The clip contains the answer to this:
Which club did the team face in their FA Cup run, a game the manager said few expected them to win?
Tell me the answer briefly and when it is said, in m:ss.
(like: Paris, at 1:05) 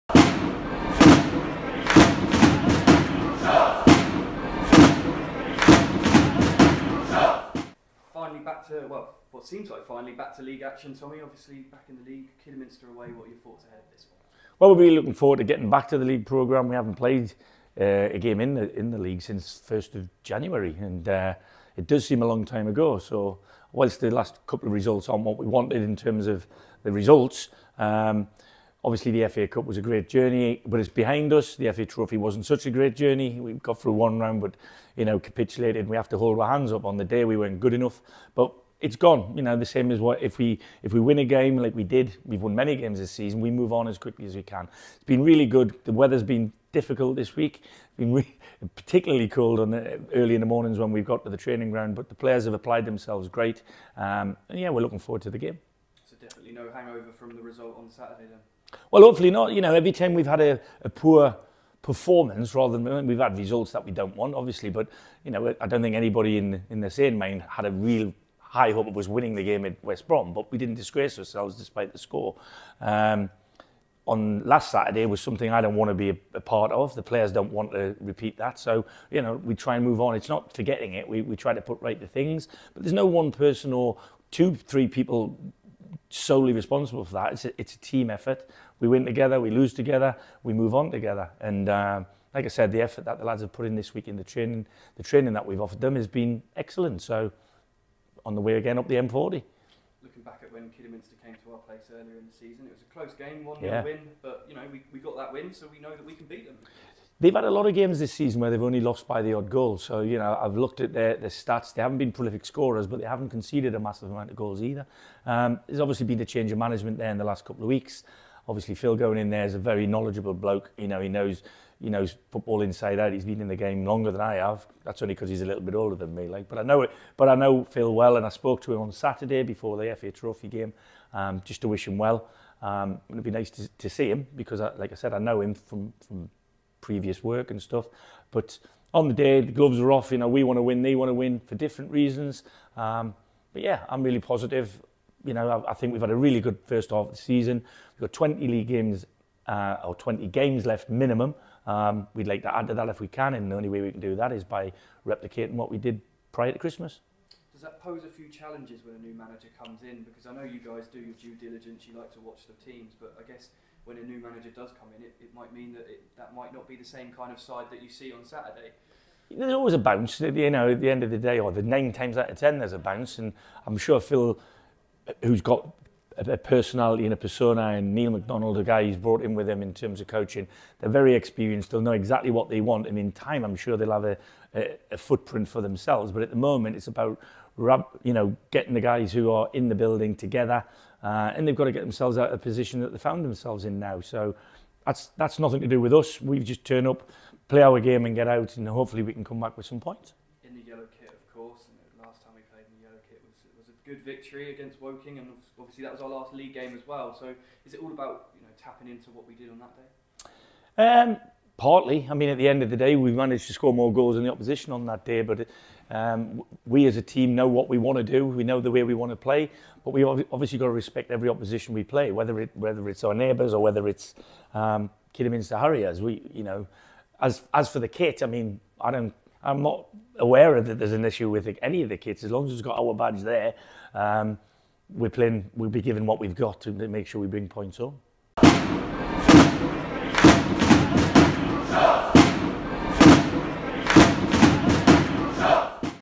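West Brom, at 1:09.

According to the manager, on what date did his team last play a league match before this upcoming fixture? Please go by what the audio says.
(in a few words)
1st of January.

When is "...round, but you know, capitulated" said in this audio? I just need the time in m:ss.
0:34.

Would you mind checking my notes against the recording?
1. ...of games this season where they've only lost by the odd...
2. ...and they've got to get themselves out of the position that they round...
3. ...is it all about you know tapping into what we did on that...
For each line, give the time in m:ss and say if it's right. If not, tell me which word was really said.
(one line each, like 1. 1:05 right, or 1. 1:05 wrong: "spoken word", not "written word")
1. 1:47 right
2. 3:11 wrong: "found", not "round"
3. 3:27 right.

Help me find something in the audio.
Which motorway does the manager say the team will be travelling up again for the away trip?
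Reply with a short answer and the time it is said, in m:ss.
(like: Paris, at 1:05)
M40, at 1:38.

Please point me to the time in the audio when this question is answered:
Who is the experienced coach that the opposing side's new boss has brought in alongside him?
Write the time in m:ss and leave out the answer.
2:57.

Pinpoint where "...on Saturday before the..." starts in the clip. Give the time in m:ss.
2:08.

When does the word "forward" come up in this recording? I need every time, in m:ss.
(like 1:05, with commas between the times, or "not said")
0:15, 0:54.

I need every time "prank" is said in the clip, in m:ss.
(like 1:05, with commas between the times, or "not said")
not said.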